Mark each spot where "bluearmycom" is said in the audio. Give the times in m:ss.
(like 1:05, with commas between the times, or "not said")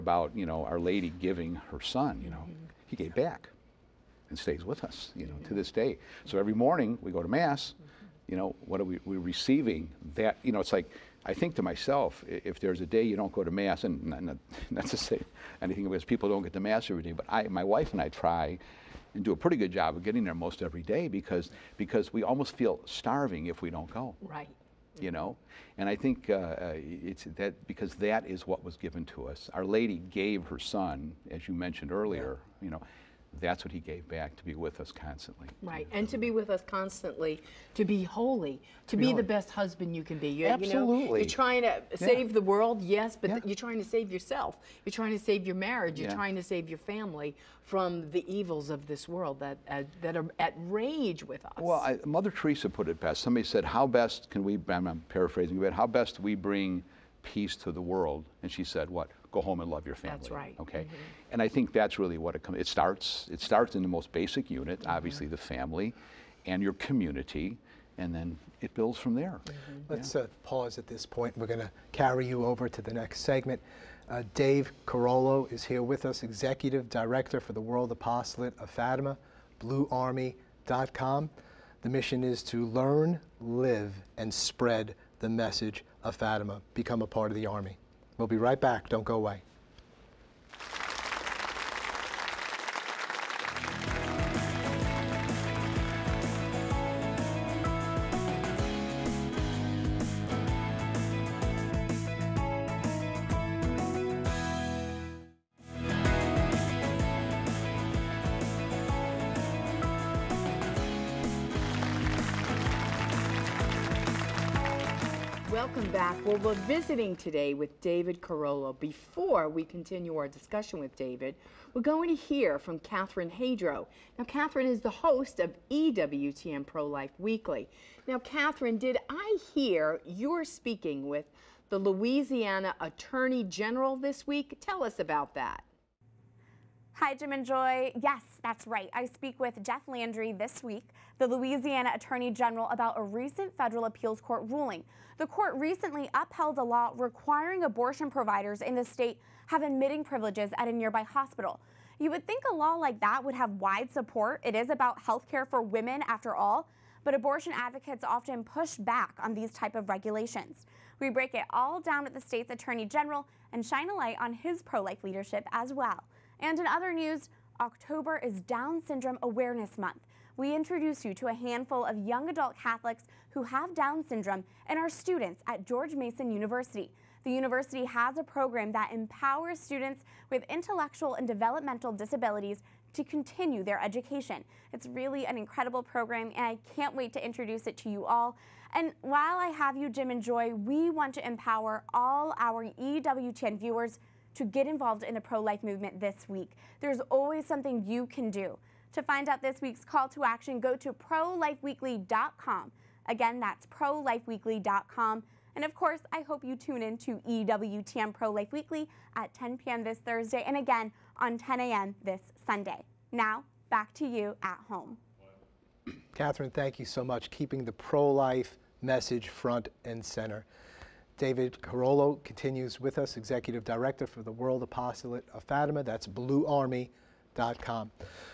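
1:19, 3:46.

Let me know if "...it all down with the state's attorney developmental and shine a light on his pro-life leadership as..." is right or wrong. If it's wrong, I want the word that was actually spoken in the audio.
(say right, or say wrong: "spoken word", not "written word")
wrong: "general", not "developmental".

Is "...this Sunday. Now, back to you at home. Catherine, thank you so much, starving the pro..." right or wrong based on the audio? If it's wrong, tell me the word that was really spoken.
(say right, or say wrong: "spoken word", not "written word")
wrong: "keeping", not "starving".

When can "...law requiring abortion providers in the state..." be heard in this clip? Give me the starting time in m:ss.
2:26.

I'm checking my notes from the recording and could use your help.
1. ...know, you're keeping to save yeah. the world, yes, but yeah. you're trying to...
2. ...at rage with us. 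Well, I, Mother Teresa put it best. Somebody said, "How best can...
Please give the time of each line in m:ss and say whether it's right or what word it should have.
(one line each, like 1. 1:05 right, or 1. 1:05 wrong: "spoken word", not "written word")
1. 0:41 wrong: "trying", not "keeping"
2. 0:50 right.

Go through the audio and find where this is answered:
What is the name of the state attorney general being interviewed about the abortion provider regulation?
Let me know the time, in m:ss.
2:19.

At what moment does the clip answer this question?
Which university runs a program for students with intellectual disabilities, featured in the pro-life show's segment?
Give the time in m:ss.
2:55.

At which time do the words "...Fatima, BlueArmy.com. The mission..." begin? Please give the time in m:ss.
1:18.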